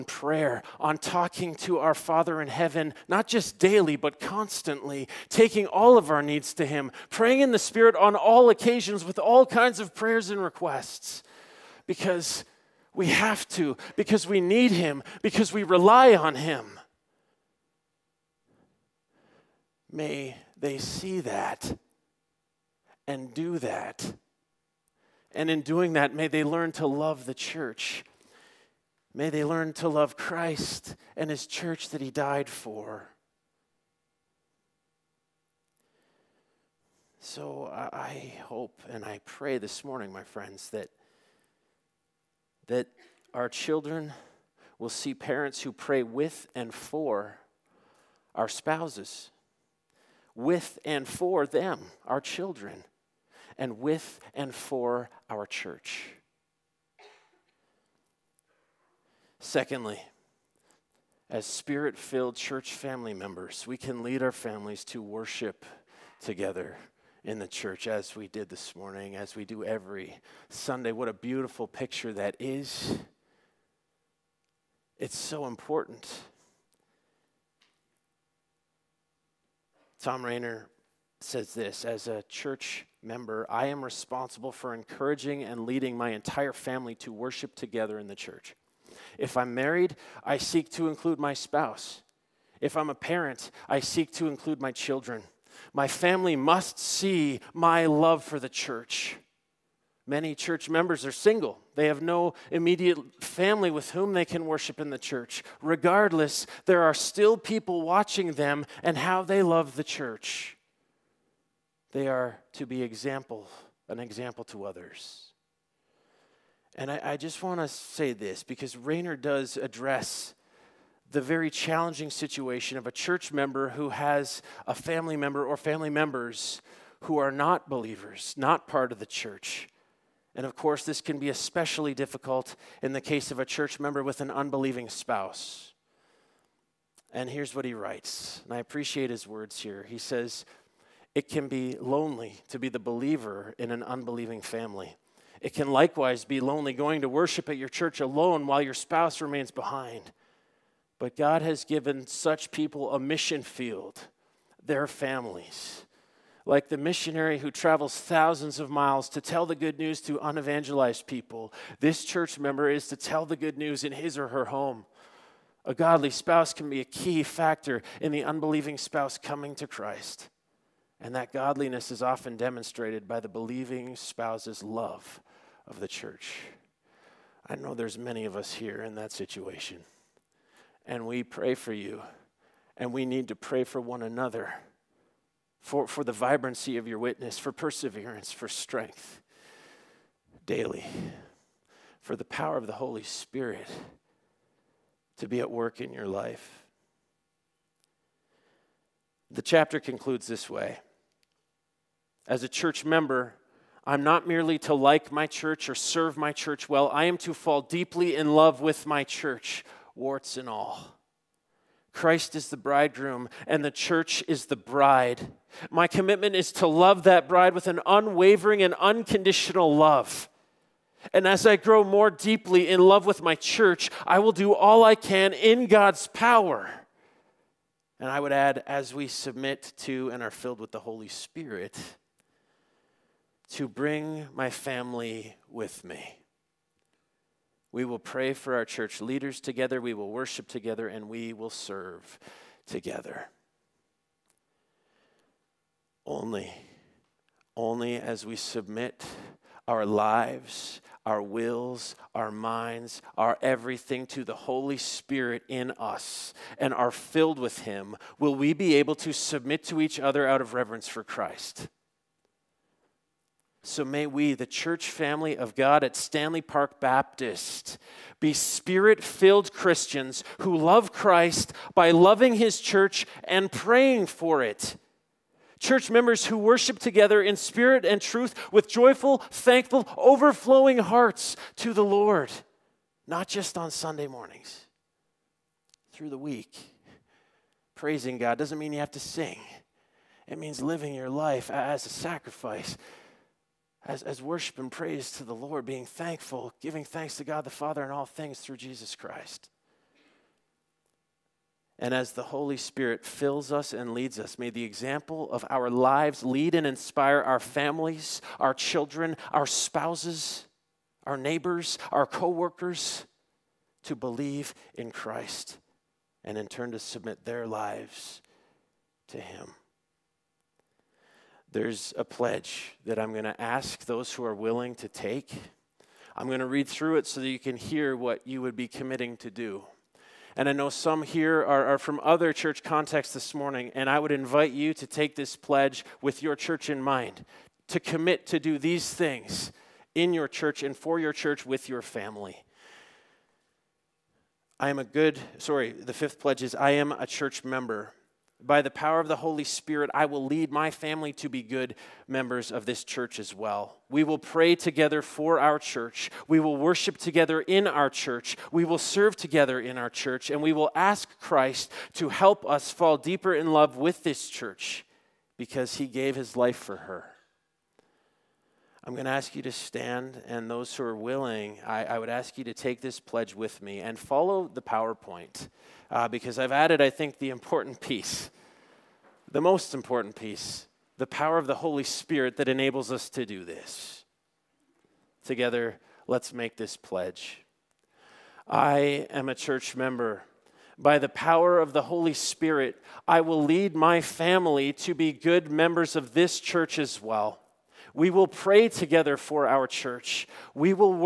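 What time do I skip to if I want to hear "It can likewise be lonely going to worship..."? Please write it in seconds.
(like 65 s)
145 s.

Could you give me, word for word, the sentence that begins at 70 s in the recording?
What a beautiful picture that is!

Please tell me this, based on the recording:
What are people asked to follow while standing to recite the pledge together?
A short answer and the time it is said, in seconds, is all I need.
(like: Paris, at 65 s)
PowerPoint, at 374 s.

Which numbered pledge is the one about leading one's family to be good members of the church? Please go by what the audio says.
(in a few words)
5th.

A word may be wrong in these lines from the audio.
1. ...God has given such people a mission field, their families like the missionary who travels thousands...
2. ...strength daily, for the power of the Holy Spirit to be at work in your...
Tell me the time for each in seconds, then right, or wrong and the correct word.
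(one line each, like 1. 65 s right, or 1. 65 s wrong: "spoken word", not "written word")
1. 151 s right
2. 188 s right.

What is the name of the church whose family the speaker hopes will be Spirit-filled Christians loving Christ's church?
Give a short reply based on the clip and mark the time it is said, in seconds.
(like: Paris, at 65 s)
Stanley Park Baptist, at 265 s.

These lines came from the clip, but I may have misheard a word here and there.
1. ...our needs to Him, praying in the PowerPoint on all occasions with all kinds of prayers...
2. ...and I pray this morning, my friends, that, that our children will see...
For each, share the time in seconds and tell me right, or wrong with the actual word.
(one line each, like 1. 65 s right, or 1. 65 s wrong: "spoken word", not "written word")
1. 6 s wrong: "Spirit", not "PowerPoint"
2. 38 s right.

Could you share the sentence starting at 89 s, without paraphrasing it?
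If I'm married, I seek to include my spouse.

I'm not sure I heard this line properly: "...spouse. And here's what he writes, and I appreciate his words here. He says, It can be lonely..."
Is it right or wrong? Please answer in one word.
right.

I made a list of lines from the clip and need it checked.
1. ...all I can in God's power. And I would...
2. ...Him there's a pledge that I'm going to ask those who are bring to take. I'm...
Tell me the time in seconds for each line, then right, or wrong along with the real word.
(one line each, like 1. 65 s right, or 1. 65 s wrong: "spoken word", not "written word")
1. 224 s right
2. 319 s wrong: "willing", not "bring".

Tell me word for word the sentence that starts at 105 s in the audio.
Regardless, there are still people watching them and how they love the church.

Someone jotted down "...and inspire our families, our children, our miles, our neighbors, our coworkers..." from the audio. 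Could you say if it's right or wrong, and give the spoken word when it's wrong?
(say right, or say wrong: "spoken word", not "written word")
wrong: "spouses", not "miles".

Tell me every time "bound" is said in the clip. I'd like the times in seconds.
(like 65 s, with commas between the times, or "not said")
not said.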